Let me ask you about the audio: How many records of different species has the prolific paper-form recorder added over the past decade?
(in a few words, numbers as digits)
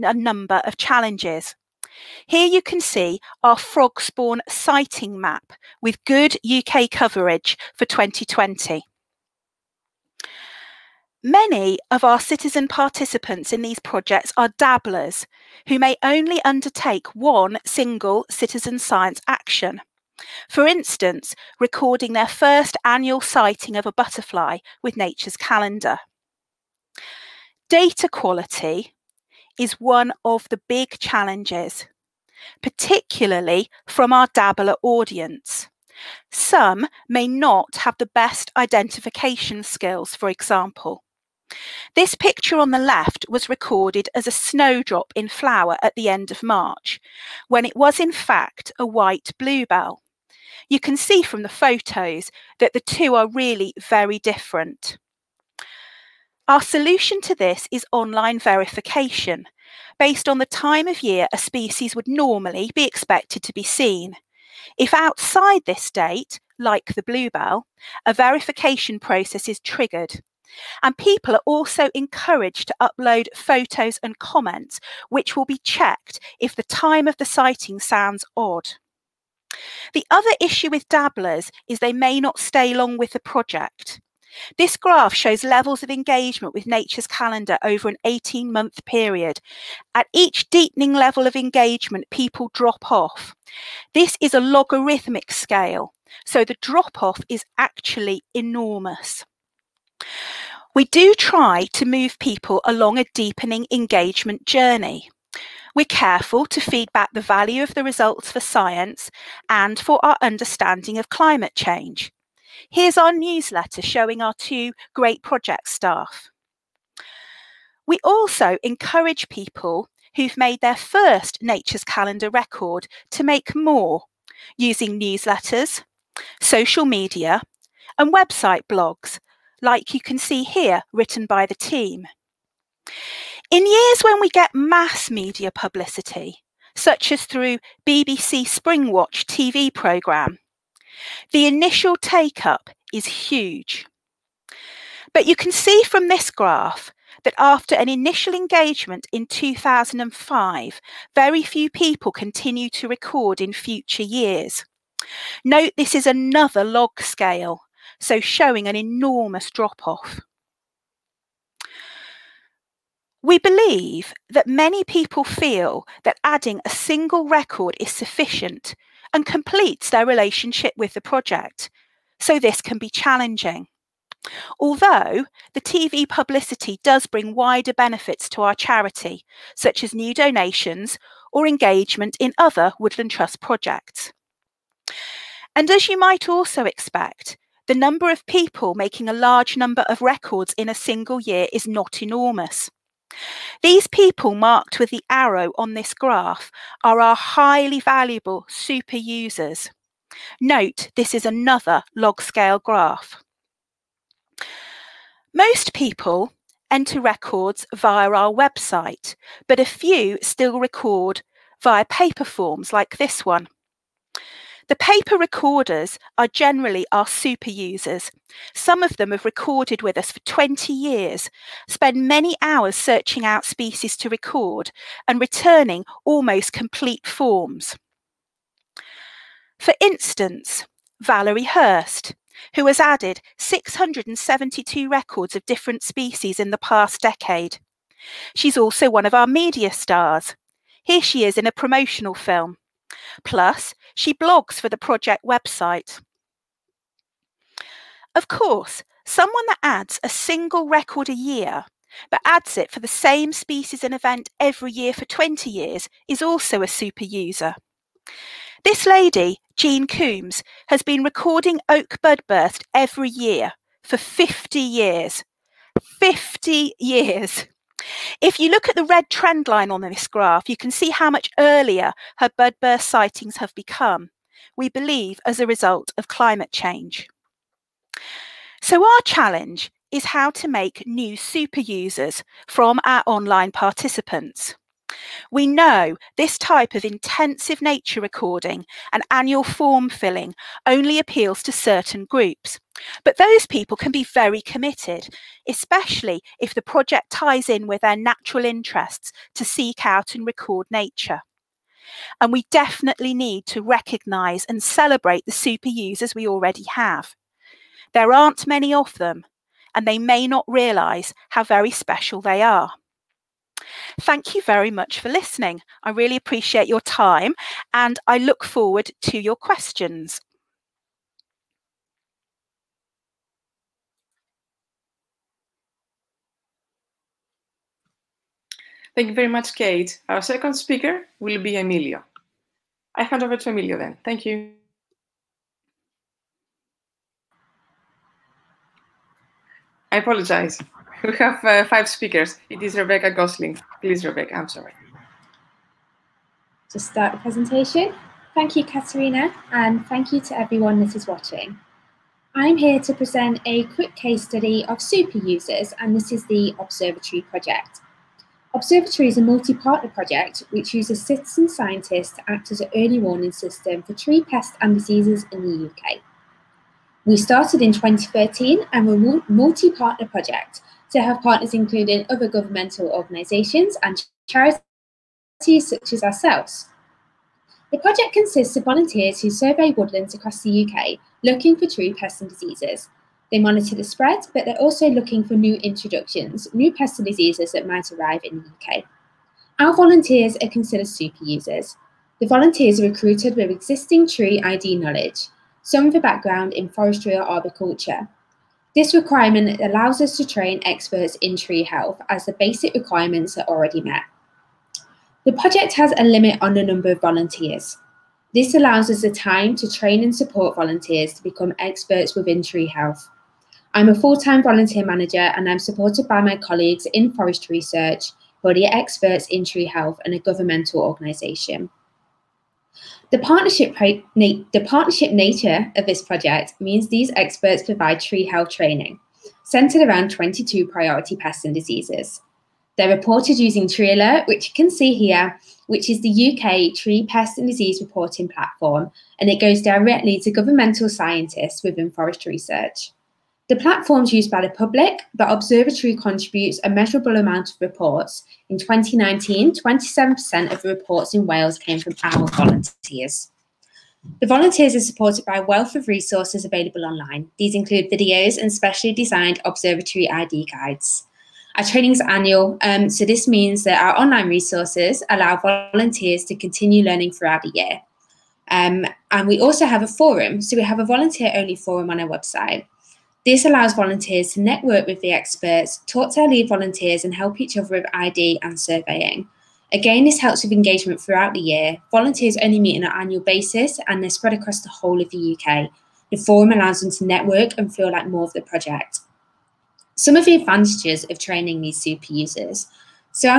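672.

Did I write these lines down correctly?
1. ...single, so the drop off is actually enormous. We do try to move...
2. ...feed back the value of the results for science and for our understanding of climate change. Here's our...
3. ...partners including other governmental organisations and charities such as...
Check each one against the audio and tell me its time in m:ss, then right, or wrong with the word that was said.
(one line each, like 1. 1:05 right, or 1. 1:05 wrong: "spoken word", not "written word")
1. 1:35 wrong: "scale", not "single"
2. 1:46 right
3. 6:11 right.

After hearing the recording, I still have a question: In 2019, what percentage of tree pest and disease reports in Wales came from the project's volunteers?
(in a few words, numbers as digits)
27%.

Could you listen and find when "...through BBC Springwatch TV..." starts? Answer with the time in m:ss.
2:17.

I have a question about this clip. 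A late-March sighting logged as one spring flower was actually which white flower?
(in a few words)
white bluebell.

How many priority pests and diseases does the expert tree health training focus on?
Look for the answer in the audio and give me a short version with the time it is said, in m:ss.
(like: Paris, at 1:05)
22, at 7:10.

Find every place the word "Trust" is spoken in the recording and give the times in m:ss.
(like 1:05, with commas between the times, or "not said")
3:03.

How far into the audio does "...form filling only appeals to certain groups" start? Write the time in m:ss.
4:49.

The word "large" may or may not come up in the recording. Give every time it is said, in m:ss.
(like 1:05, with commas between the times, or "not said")
3:09.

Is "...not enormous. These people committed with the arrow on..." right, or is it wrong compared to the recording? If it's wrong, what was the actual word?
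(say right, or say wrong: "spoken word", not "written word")
wrong: "marked", not "committed".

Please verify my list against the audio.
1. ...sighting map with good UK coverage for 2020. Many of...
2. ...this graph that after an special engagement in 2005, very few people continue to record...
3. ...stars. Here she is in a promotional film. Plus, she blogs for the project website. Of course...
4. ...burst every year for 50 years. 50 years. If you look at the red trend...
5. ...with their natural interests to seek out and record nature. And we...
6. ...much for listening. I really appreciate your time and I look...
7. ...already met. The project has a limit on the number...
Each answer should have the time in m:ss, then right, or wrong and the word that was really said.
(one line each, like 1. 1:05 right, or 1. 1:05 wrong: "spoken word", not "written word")
1. 0:04 right
2. 2:26 wrong: "initial", not "special"
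3. 3:59 right
4. 4:22 right
5. 4:57 right
6. 5:14 right
7. 6:43 right.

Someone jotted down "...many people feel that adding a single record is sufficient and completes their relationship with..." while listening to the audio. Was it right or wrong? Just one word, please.
right.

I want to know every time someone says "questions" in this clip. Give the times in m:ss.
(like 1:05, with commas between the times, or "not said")
5:19.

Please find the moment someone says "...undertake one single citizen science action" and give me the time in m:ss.
0:16.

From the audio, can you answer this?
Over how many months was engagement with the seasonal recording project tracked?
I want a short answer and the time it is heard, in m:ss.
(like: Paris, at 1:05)
18, at 1:28.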